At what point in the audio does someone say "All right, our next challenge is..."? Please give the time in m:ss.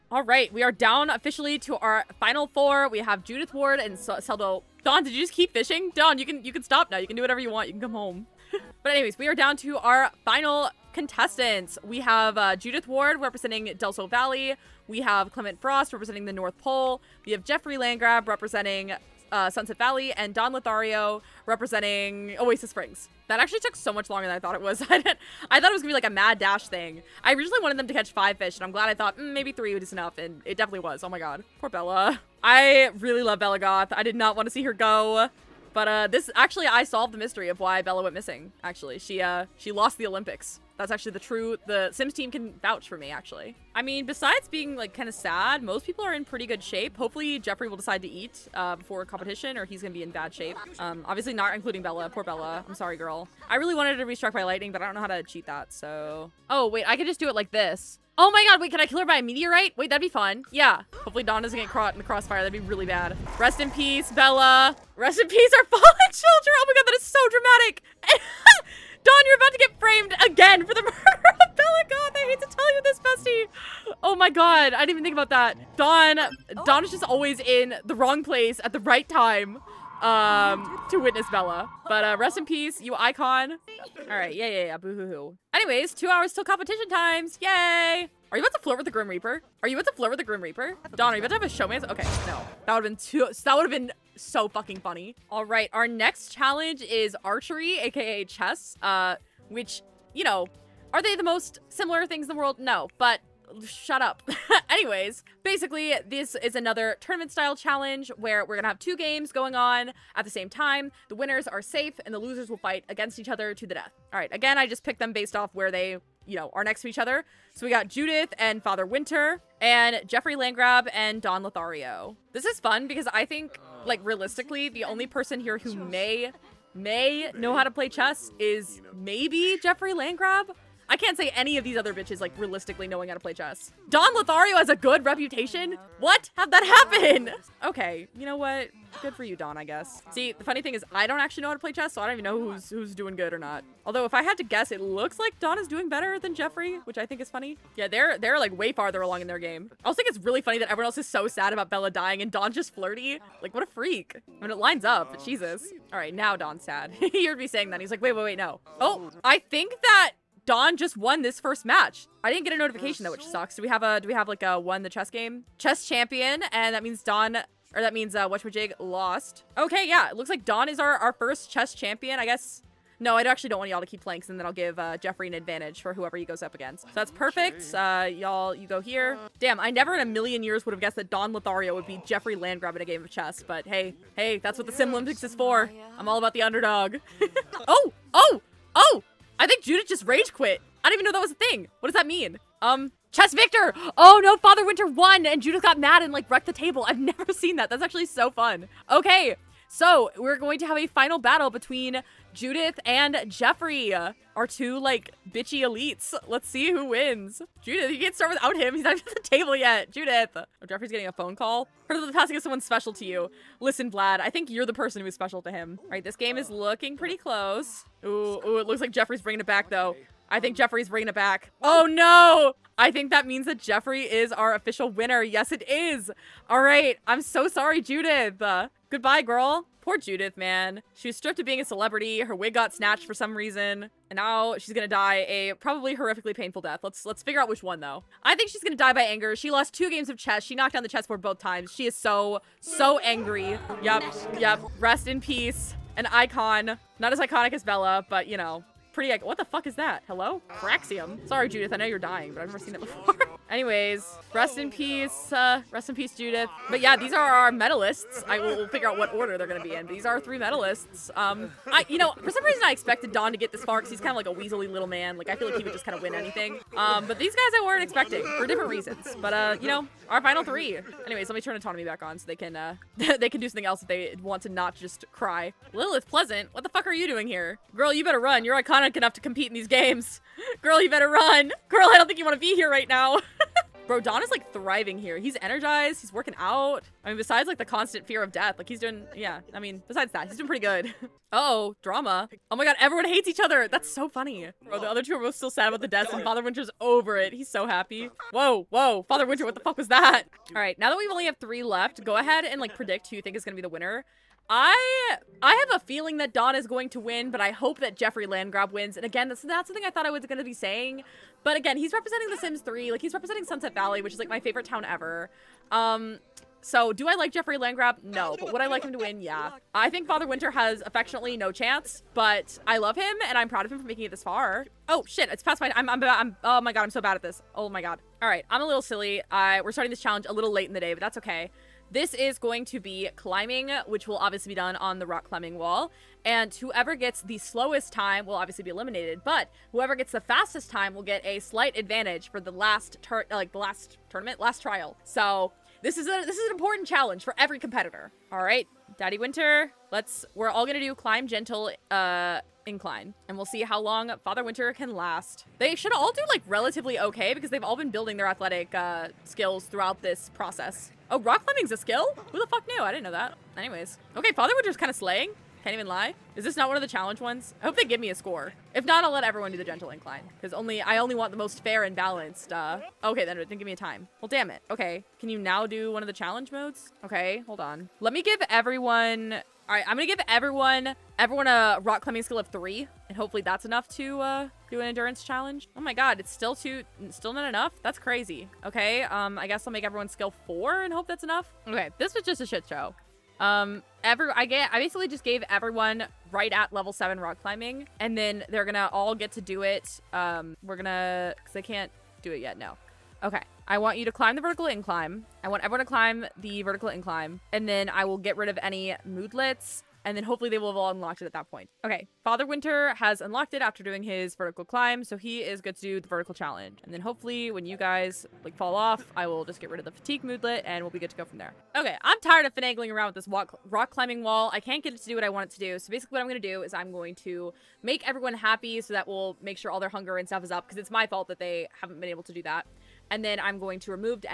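1:35.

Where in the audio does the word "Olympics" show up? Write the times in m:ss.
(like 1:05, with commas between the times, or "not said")
0:40, 3:04.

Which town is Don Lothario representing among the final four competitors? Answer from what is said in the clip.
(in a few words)
Oasis Springs.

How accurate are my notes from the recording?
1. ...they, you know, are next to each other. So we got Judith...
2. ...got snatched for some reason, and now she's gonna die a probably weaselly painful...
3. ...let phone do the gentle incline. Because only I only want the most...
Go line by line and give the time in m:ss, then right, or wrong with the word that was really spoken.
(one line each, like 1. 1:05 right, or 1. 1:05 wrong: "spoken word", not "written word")
1. 1:55 right
2. 3:52 wrong: "horrifically", not "weaselly"
3. 6:09 wrong: "everyone", not "phone".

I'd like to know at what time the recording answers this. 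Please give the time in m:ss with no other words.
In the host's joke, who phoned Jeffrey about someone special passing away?
3:33.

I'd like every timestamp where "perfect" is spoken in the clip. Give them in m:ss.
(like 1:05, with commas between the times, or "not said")
2:57.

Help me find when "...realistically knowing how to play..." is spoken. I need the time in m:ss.
2:12.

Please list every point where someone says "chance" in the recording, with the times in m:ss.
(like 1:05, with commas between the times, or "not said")
5:21.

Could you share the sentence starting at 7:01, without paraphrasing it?
Okay, I'm tired of finagling around with this rock climbing wall.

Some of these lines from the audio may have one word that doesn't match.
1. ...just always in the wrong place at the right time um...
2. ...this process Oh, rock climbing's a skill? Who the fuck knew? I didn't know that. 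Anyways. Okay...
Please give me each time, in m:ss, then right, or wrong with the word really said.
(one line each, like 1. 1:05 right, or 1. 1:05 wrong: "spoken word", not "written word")
1. 1:16 right
2. 6:00 right.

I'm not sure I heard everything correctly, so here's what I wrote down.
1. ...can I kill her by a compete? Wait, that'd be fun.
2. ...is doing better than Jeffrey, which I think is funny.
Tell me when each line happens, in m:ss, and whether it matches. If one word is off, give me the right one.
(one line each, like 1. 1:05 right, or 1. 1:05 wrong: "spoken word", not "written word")
1. 0:58 wrong: "meteorite", not "compete"
2. 2:25 right.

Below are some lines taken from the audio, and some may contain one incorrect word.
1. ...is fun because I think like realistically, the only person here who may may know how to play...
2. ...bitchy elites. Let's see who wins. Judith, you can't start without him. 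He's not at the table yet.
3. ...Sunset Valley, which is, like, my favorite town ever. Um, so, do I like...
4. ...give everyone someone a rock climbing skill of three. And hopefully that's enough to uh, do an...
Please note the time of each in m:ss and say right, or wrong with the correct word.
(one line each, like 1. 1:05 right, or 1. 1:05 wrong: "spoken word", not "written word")
1. 2:02 right
2. 3:25 right
3. 5:13 right
4. 6:20 wrong: "everyone", not "someone".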